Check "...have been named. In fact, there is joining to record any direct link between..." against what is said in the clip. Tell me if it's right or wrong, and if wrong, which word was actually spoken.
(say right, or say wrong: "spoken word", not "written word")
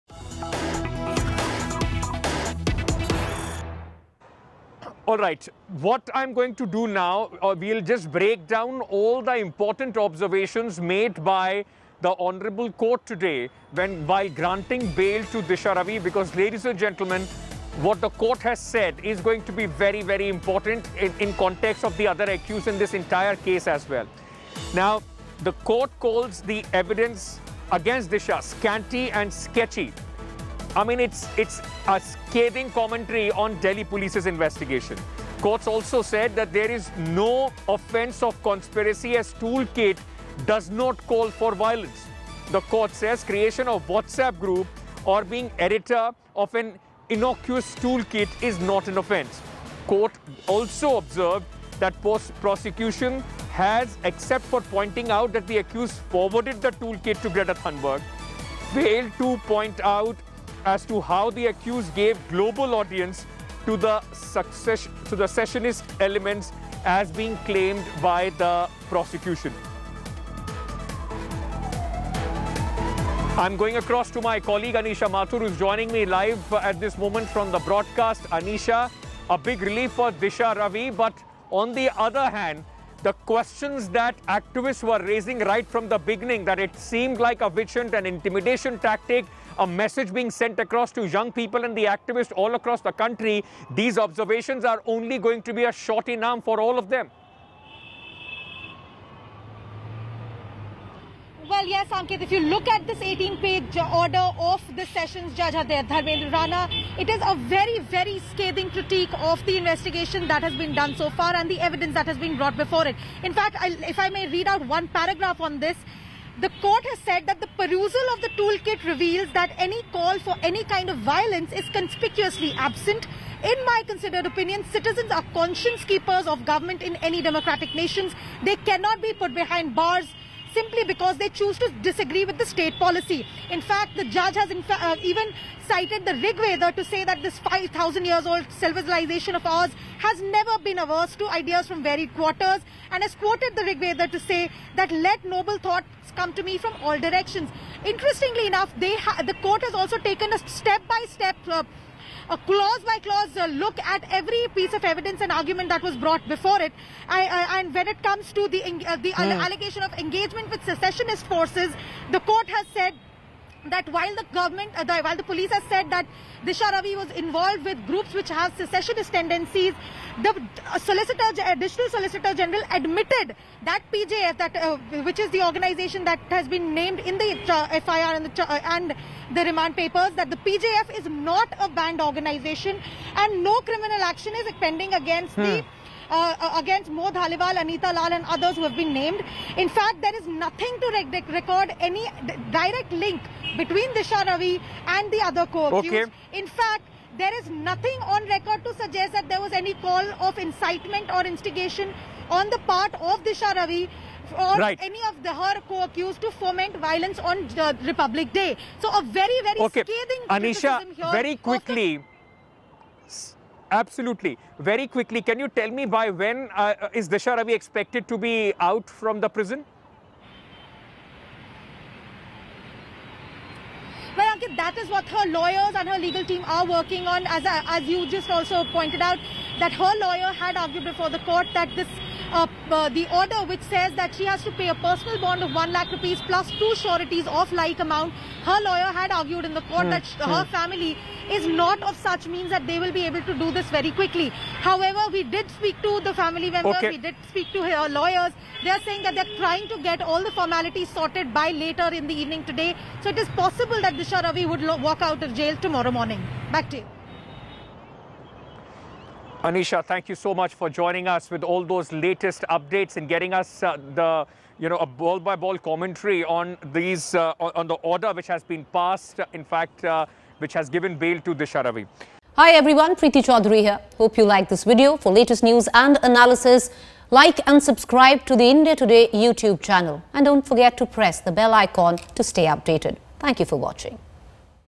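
wrong: "nothing", not "joining".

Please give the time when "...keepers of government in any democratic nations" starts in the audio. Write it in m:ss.
2:05.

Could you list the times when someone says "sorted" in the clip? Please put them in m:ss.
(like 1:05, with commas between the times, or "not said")
4:10.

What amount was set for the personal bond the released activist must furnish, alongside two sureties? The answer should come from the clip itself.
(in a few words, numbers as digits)
1 lakh rupees.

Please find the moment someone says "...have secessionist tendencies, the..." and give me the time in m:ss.
2:48.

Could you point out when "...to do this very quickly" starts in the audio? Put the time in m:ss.
4:03.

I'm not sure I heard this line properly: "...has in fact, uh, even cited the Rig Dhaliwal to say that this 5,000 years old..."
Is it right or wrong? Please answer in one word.
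wrong.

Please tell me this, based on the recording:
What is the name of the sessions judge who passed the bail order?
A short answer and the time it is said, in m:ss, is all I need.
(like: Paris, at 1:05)
Dharmendra Rana, at 1:45.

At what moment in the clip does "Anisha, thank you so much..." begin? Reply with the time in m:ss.
4:19.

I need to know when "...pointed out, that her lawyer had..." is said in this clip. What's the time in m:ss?
3:48.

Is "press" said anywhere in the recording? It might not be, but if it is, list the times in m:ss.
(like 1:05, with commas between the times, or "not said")
4:40.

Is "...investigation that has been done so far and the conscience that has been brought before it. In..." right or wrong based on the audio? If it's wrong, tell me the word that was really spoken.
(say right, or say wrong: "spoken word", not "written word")
wrong: "evidence", not "conscience".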